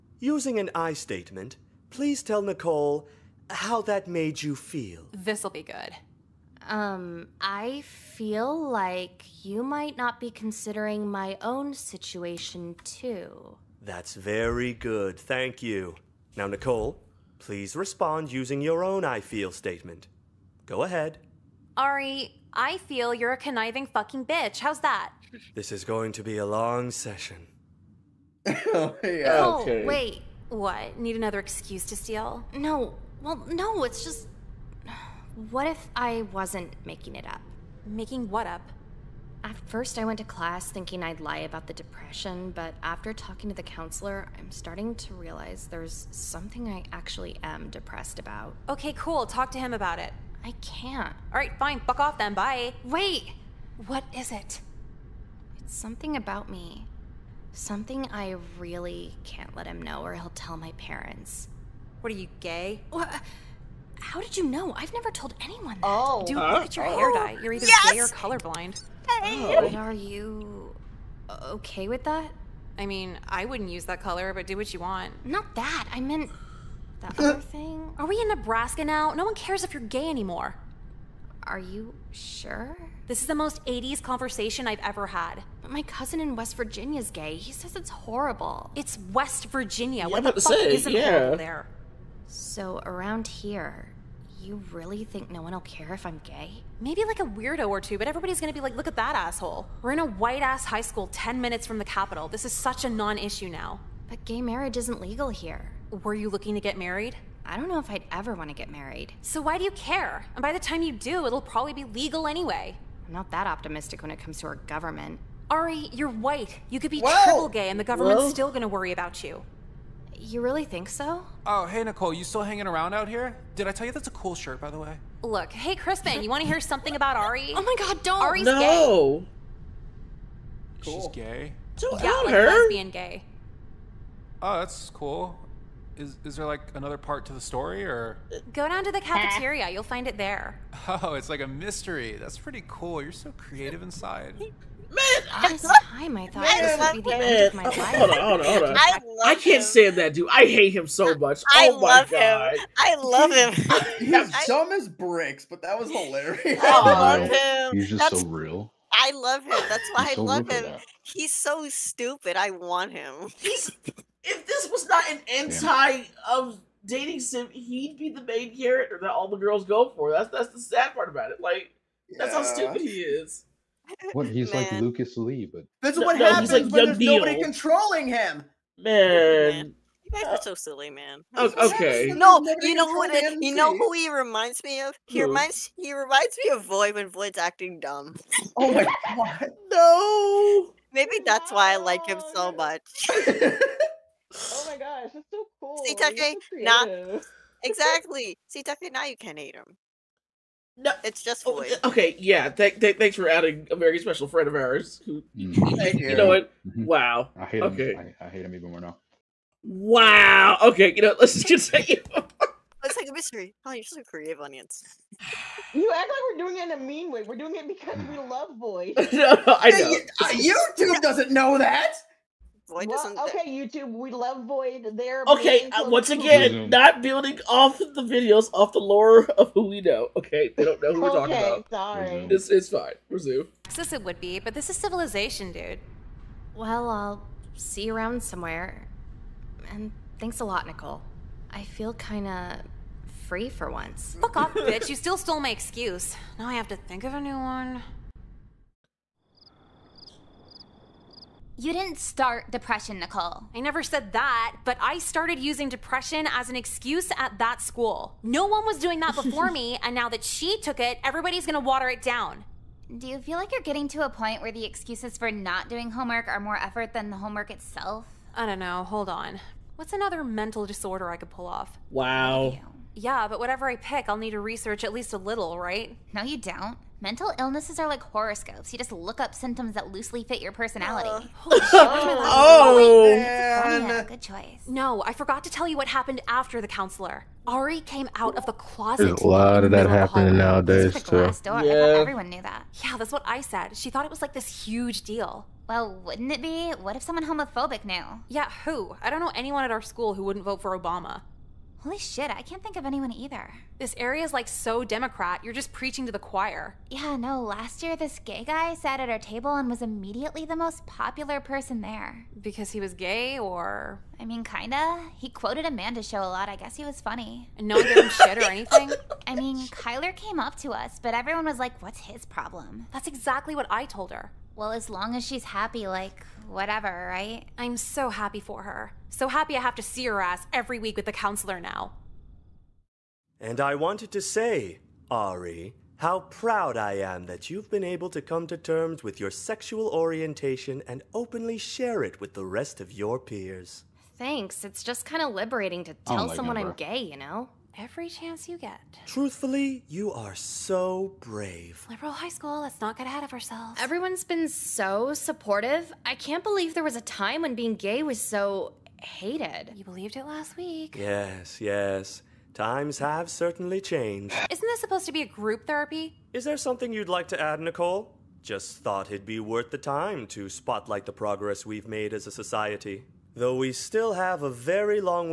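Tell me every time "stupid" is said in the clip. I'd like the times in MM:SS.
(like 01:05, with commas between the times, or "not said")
02:41, 02:52.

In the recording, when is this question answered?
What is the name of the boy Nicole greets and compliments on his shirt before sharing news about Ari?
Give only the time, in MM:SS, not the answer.
02:05.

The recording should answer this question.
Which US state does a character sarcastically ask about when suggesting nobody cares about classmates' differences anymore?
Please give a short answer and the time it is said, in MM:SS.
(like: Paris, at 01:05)
Nebraska, at 01:18.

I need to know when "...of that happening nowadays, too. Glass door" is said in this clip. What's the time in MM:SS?
04:49.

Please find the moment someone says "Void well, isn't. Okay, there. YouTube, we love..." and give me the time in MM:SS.
03:42.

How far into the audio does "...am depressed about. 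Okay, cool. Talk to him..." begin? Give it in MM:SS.
00:47.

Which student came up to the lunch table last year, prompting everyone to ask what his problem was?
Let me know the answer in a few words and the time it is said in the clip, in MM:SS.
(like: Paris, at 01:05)
Kyler, at 05:19.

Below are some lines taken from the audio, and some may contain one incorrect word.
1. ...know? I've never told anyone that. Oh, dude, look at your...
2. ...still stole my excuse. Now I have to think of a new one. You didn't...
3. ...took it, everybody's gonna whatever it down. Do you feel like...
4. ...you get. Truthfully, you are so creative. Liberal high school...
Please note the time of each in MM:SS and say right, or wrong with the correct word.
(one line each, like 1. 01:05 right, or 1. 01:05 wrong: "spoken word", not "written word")
1. 01:04 right
2. 04:04 right
3. 04:20 wrong: "water", not "whatever"
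4. 05:48 wrong: "brave", not "creative".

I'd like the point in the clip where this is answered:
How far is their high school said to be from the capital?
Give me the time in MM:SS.
01:41.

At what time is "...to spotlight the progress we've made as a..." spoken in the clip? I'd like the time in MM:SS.
06:10.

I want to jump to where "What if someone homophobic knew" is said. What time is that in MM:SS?
04:56.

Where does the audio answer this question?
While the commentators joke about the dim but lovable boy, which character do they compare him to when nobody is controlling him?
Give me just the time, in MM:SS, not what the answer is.
02:54.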